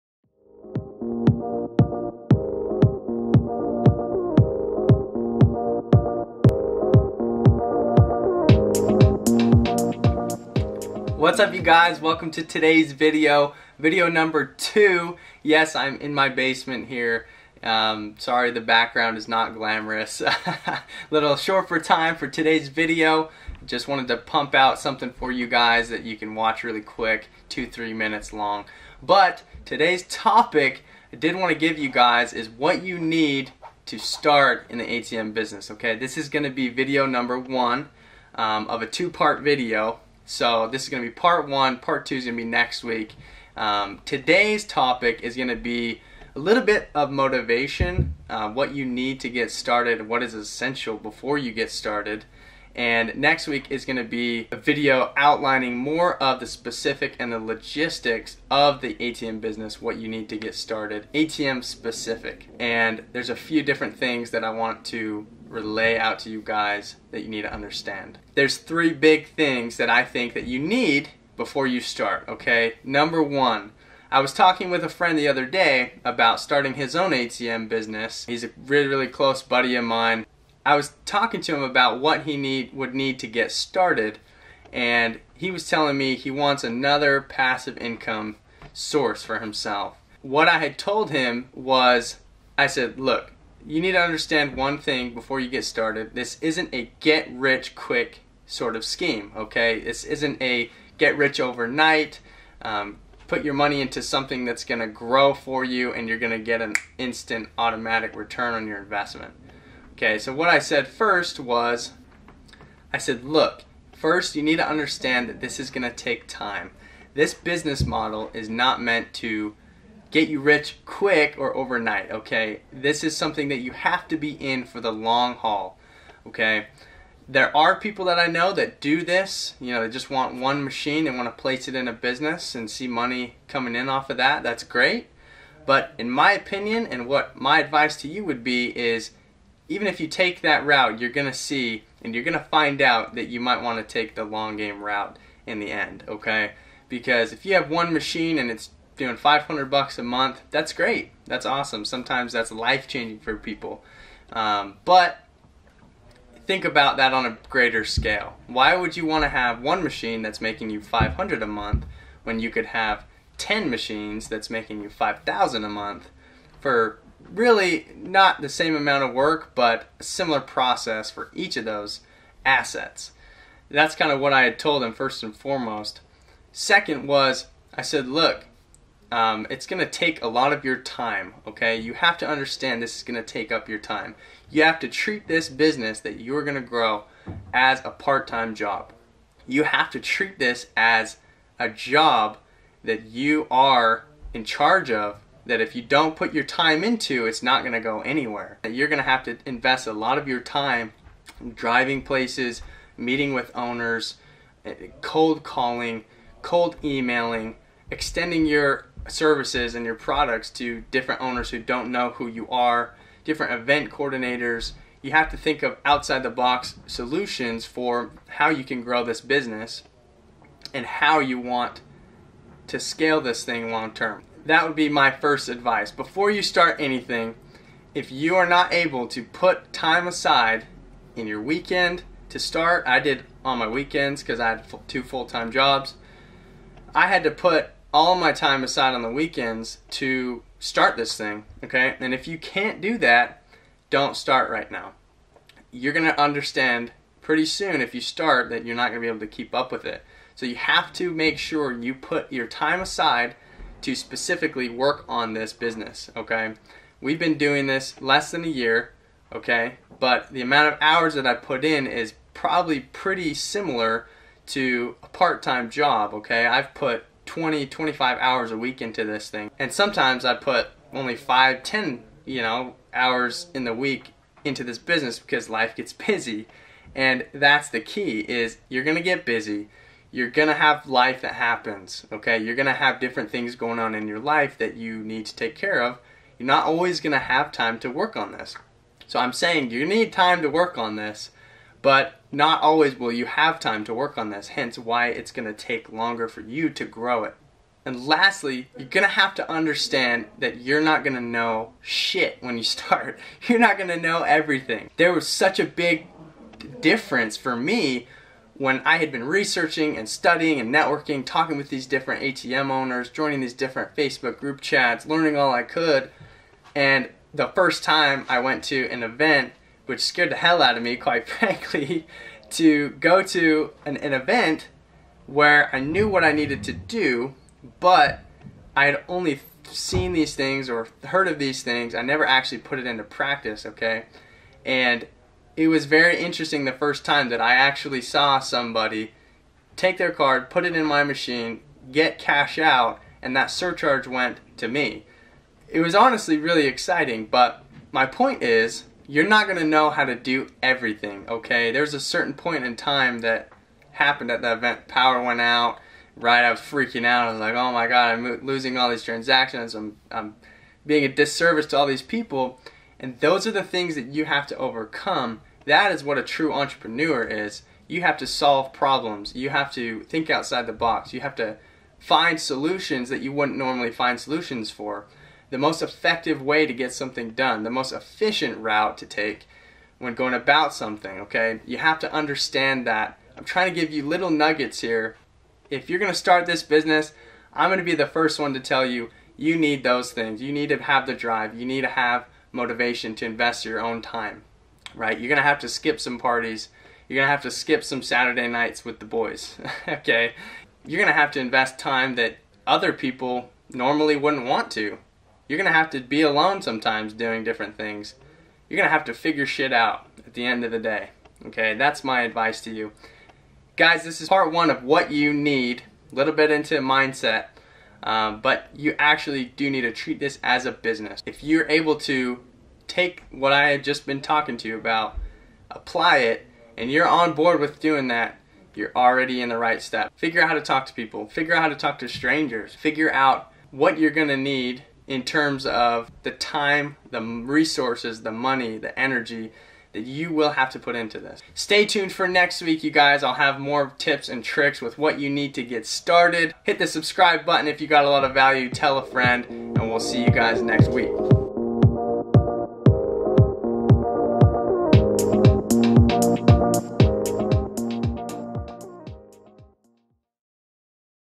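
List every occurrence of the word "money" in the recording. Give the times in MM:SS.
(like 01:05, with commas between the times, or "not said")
01:43, 02:12, 07:18.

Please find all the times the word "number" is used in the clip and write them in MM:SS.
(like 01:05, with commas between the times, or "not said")
00:14, 00:37, 01:12.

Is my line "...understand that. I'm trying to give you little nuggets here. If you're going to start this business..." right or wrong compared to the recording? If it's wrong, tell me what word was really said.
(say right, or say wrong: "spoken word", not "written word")
right.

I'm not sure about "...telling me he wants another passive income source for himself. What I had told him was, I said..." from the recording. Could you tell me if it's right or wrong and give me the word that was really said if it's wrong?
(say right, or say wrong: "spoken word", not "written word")
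right.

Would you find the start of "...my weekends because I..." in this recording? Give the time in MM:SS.
03:53.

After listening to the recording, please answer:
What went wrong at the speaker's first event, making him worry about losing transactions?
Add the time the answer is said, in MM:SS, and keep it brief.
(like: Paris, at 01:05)
power went out, at 05:54.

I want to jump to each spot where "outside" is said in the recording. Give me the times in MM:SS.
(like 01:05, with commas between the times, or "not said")
03:35, 06:10.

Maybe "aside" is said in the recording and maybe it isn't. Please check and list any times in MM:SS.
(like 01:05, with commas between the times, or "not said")
03:50, 03:58, 04:12.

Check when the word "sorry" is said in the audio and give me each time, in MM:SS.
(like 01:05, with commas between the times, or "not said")
00:18.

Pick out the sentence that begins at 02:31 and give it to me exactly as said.
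Sometimes that's life changing for people.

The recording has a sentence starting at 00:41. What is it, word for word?
Part two is going to be next week.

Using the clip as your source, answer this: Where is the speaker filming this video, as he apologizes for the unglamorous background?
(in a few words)
basement.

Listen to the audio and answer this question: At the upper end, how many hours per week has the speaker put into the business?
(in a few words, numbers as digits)
25.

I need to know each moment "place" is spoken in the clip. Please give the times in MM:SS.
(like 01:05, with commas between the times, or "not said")
02:11, 03:22.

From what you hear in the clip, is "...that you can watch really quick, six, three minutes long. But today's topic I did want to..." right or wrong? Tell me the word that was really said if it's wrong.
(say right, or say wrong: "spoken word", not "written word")
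wrong: "two", not "six".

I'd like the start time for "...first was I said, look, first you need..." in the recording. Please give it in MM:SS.
01:50.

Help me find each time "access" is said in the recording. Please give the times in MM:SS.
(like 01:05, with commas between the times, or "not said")
not said.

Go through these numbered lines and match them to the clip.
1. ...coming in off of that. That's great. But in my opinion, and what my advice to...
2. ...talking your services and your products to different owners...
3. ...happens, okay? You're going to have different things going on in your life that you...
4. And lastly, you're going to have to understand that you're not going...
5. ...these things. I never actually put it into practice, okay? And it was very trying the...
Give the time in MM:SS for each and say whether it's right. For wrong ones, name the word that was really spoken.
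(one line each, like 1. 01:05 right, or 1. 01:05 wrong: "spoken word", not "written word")
1. 02:13 right
2. 03:27 wrong: "extending", not "talking"
3. 04:41 right
4. 04:57 right
5. 05:31 wrong: "interesting", not "trying".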